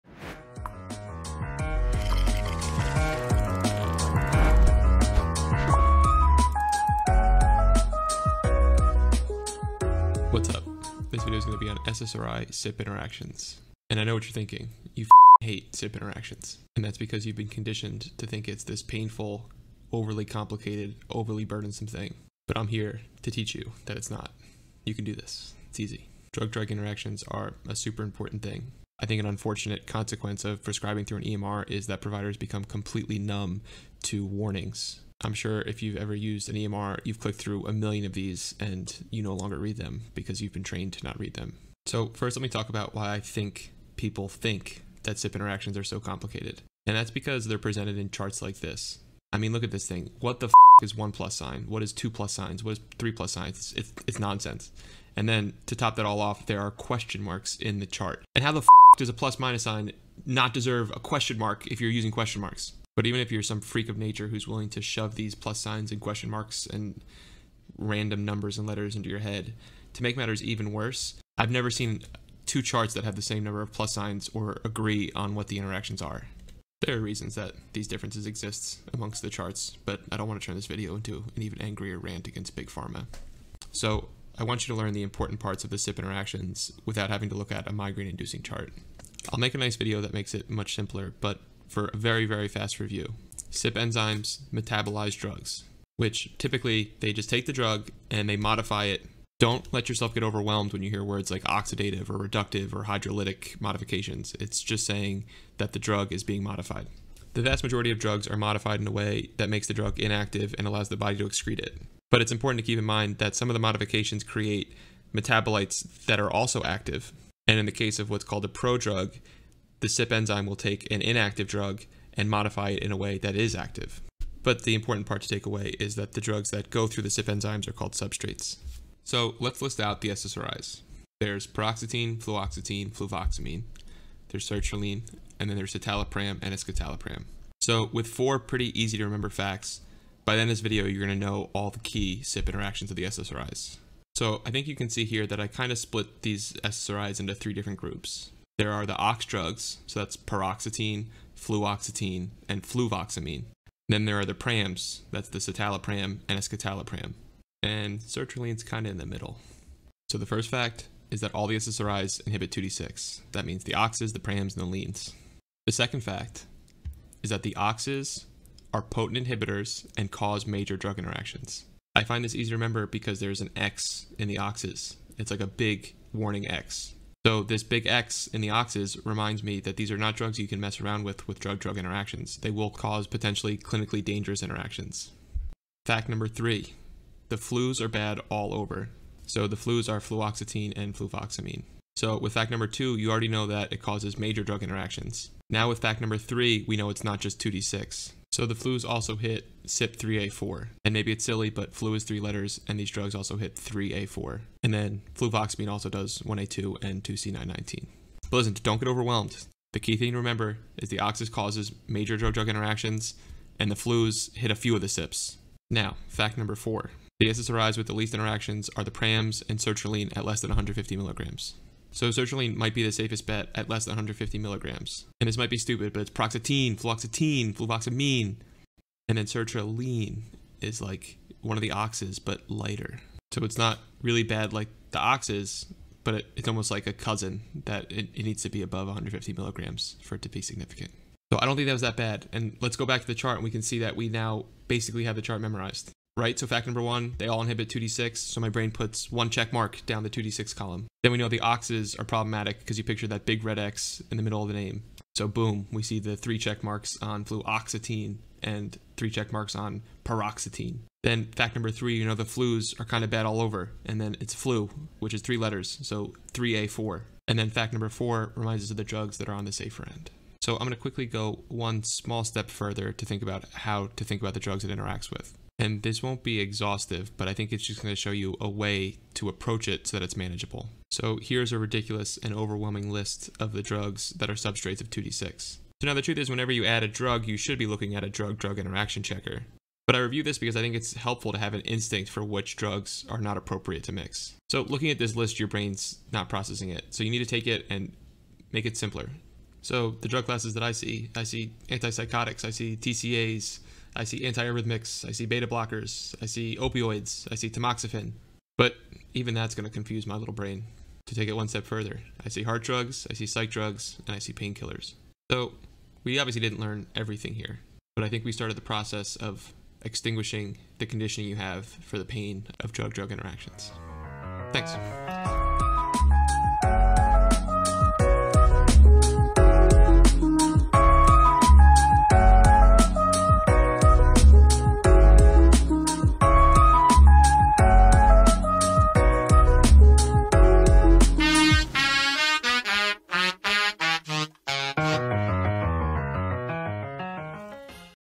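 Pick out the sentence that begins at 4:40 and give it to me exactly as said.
So here's a ridiculous and overwhelming list of the drugs that are substrates of 2D6.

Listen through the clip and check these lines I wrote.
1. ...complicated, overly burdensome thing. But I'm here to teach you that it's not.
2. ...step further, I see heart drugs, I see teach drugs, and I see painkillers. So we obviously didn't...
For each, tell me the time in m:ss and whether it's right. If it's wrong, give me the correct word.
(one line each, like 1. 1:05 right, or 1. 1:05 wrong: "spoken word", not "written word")
1. 0:20 right
2. 5:11 wrong: "psych", not "teach".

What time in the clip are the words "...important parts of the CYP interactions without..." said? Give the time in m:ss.
1:25.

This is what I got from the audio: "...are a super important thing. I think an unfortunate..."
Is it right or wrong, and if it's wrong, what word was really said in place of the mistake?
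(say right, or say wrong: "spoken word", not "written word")
right.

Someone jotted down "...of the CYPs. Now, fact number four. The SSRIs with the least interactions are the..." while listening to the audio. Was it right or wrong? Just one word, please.
right.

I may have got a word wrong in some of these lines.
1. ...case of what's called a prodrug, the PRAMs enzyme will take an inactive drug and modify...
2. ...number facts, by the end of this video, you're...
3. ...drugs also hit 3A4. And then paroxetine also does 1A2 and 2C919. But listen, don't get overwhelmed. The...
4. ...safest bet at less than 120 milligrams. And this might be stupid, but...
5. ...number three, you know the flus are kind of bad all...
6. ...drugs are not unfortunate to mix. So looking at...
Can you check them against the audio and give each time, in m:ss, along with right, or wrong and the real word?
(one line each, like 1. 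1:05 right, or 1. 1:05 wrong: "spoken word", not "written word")
1. 1:57 wrong: "CYP", not "PRAMs"
2. 2:19 wrong: "remember", not "number"
3. 3:22 wrong: "fluvoxamine", not "paroxetine"
4. 3:42 wrong: "150", not "120"
5. 4:21 right
6. 4:52 wrong: "appropriate", not "unfortunate".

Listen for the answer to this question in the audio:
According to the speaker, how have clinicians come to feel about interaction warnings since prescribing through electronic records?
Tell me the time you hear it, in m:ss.
0:32.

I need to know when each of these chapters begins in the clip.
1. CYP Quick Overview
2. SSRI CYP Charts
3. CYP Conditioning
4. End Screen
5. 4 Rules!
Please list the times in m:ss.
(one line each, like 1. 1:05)
1. 1:30
2. 0:44
3. 0:10
4. 5:24
5. 2:10.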